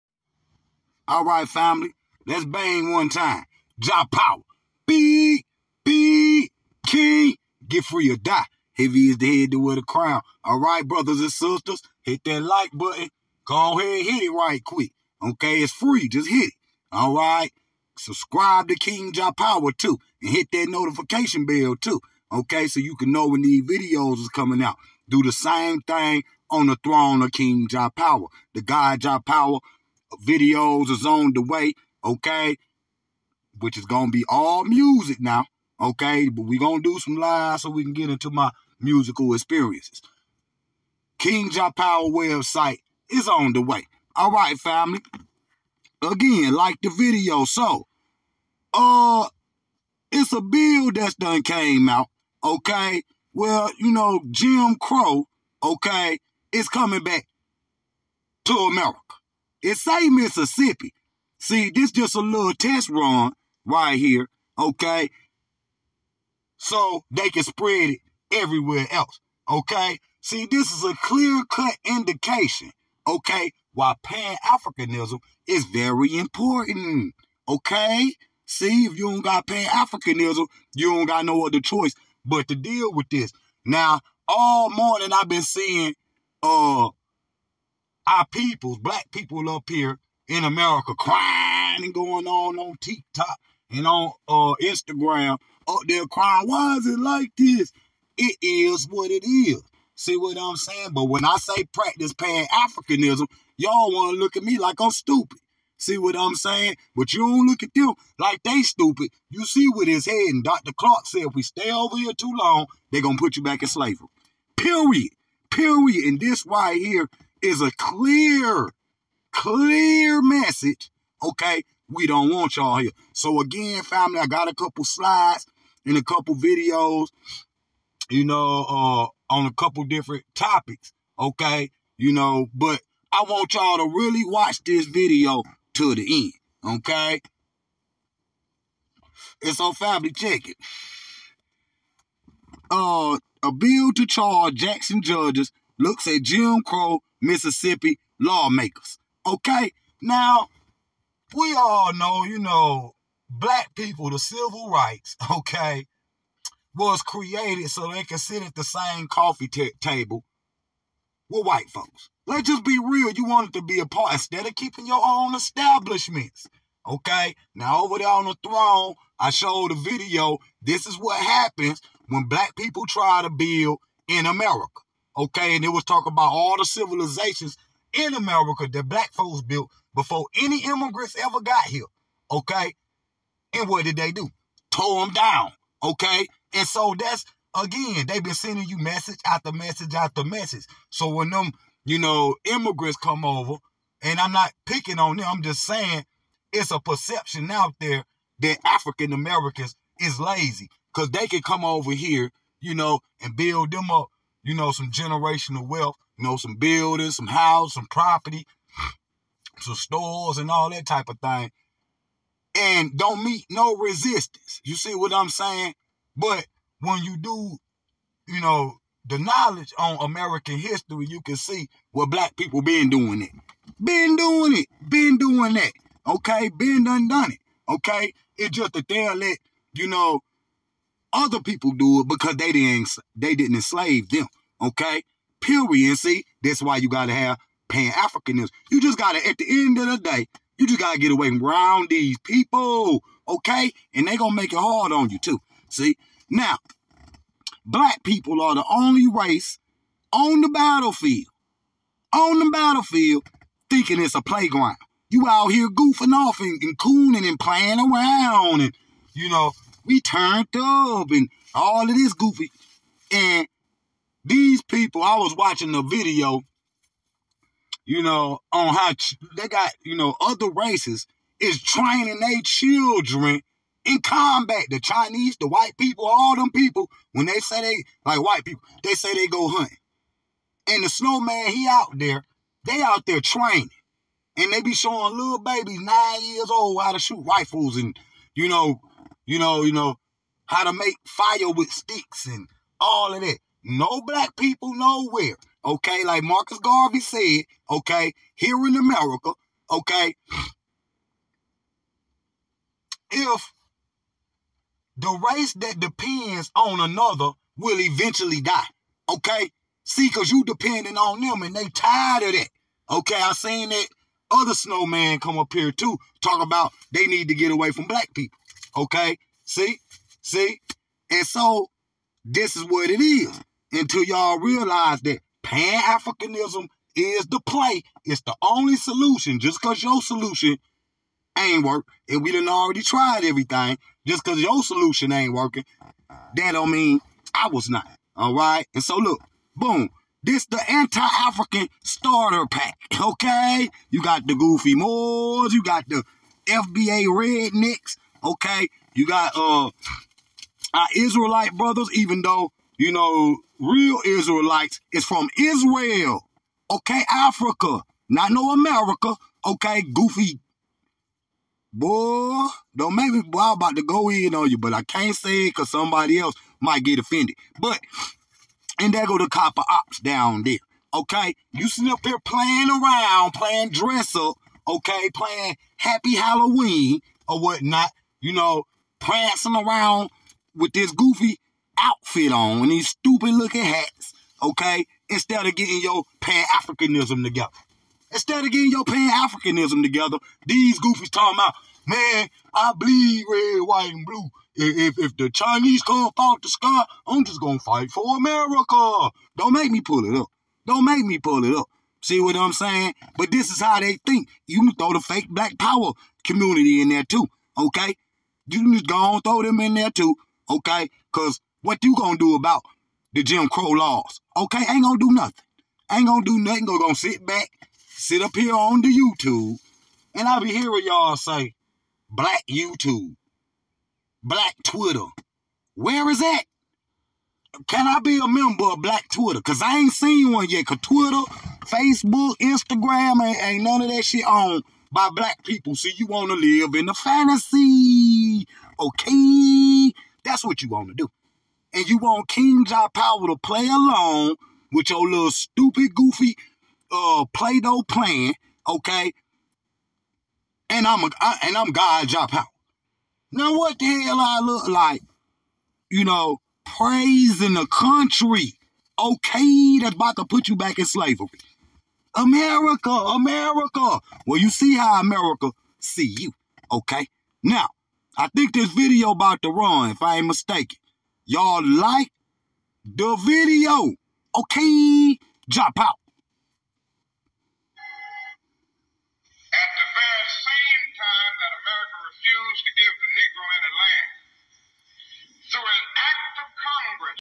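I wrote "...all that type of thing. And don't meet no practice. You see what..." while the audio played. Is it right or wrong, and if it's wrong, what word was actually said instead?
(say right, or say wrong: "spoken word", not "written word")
wrong: "resistance", not "practice".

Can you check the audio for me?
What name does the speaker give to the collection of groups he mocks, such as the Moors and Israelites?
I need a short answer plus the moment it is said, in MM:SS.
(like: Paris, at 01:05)
anti-African starter pack, at 05:40.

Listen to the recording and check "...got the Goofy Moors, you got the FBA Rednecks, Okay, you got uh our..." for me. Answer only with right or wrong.
right.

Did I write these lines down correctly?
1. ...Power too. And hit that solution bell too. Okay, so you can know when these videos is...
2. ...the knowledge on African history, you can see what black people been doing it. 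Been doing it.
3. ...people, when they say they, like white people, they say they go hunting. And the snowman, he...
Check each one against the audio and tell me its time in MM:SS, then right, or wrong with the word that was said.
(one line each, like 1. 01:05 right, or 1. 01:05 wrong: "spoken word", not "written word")
1. 00:19 wrong: "notification", not "solution"
2. 03:39 wrong: "American", not "African"
3. 04:36 right.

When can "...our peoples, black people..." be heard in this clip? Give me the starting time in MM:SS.
01:28.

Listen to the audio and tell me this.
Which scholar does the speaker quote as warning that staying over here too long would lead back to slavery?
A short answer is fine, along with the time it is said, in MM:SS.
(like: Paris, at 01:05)
Dr. Clarke, at 01:50.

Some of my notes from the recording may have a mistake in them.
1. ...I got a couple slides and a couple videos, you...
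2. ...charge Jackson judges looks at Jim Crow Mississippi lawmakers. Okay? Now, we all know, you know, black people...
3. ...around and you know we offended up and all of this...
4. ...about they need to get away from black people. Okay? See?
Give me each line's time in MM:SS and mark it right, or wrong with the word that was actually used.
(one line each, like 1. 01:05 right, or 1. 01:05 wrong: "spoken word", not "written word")
1. 02:04 right
2. 02:24 right
3. 04:17 wrong: "turned", not "offended"
4. 05:16 right.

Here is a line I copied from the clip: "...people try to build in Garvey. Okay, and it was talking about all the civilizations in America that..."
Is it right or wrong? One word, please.
wrong.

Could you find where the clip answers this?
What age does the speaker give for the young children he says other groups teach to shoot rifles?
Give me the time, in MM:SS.
04:45.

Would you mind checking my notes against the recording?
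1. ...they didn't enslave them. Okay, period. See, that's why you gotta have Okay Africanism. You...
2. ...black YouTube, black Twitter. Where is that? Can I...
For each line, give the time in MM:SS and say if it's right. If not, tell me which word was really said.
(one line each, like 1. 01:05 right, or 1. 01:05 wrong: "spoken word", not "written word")
1. 03:53 wrong: "Pan", not "Okay"
2. 07:02 right.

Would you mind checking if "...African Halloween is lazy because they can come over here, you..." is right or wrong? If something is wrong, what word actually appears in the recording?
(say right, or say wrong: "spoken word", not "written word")
wrong: "Americans", not "Halloween".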